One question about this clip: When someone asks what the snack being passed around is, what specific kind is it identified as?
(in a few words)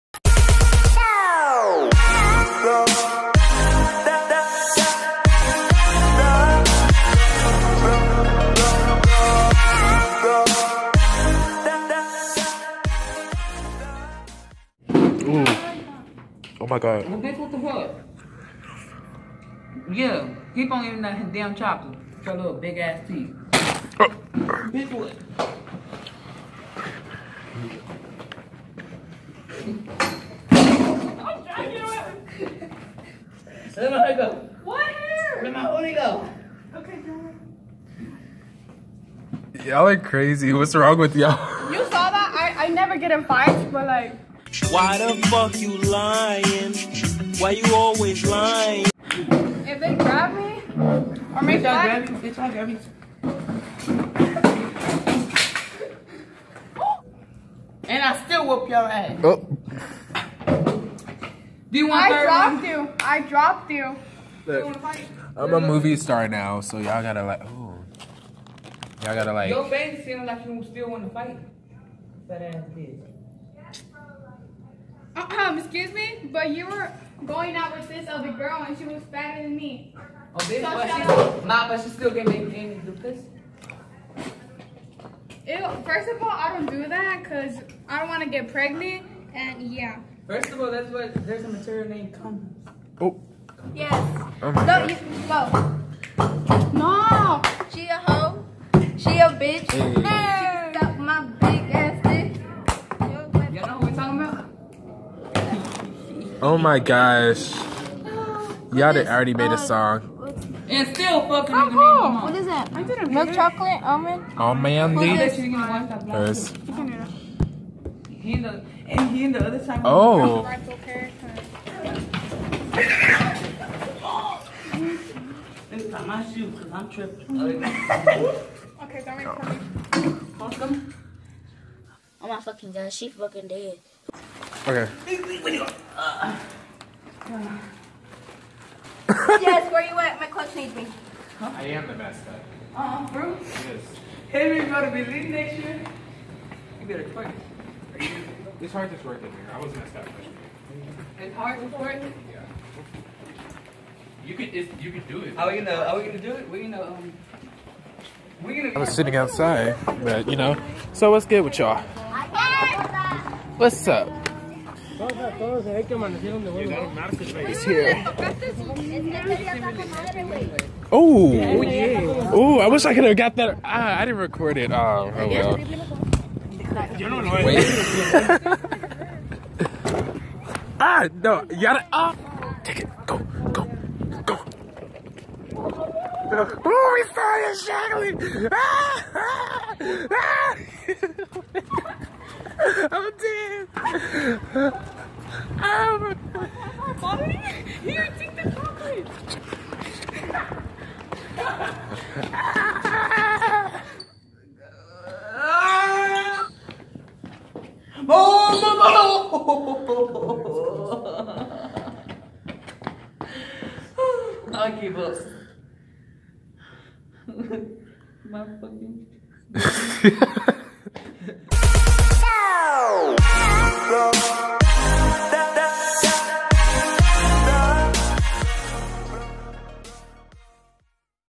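Milk chocolate almond.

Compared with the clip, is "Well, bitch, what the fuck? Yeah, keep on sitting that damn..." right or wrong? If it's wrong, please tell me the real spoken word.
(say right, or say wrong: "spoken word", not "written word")
wrong: "eating", not "sitting".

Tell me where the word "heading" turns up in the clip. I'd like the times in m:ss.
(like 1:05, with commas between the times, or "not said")
not said.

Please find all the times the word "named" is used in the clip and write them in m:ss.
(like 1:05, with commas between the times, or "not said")
1:31.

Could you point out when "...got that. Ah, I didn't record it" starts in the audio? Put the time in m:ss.
2:53.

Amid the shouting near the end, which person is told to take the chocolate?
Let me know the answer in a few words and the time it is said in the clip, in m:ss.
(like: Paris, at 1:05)
Bobby, at 3:17.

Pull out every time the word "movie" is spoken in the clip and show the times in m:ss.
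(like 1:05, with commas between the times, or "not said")
1:05.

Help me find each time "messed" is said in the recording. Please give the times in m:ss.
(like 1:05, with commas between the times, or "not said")
2:29.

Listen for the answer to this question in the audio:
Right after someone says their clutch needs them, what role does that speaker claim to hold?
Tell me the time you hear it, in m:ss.
2:21.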